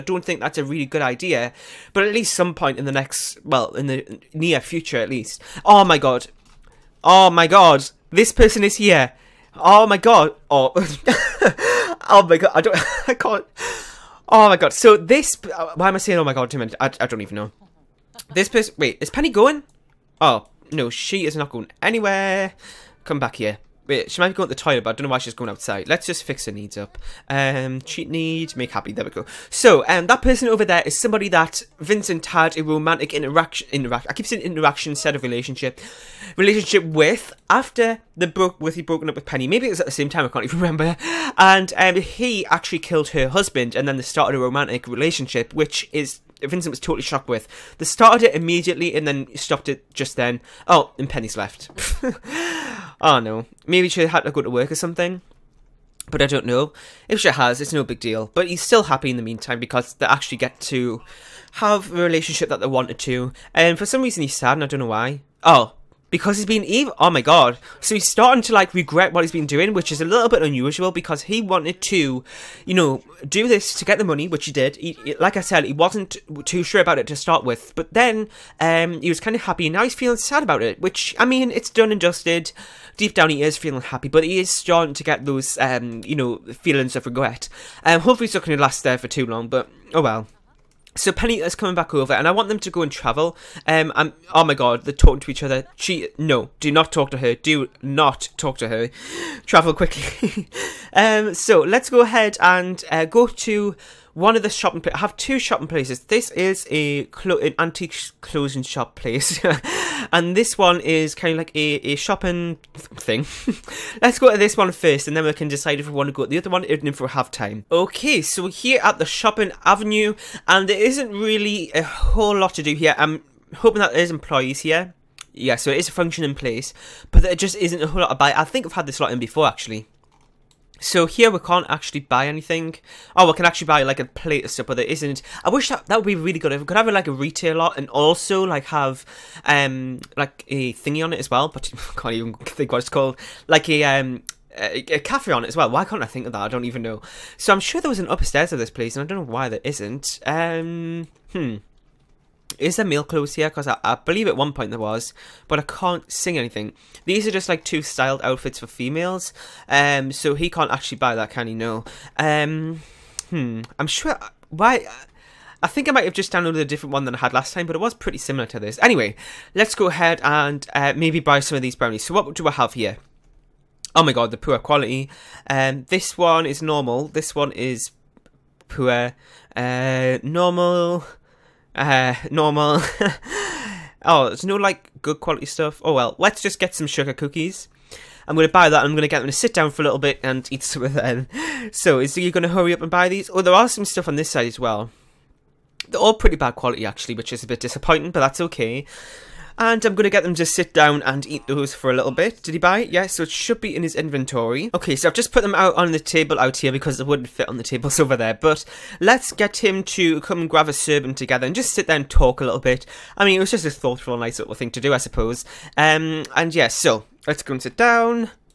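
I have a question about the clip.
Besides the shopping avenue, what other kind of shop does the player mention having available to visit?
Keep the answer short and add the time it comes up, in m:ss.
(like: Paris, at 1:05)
antique clothing shop, at 1:47.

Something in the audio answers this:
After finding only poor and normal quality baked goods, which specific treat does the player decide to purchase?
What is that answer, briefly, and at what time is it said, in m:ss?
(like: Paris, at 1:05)
sugar cookies, at 3:06.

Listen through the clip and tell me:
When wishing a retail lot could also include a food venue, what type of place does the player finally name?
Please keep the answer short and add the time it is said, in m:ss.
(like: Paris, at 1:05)
cafe, at 2:24.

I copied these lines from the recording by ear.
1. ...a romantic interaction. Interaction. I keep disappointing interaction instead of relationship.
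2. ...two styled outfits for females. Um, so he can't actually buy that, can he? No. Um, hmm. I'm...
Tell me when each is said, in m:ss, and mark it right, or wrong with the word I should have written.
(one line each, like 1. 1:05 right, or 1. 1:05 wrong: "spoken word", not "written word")
1. 0:32 wrong: "saying", not "disappointing"
2. 2:37 right.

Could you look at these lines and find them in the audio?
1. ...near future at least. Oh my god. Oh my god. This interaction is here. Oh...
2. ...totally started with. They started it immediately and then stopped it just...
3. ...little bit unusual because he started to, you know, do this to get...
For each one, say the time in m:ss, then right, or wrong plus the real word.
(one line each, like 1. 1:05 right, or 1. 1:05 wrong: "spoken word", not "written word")
1. 0:04 wrong: "person", not "interaction"
2. 0:46 wrong: "shocked", not "started"
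3. 1:10 wrong: "wanted", not "started".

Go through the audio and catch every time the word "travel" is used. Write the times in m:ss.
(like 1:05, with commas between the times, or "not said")
1:32, 1:39.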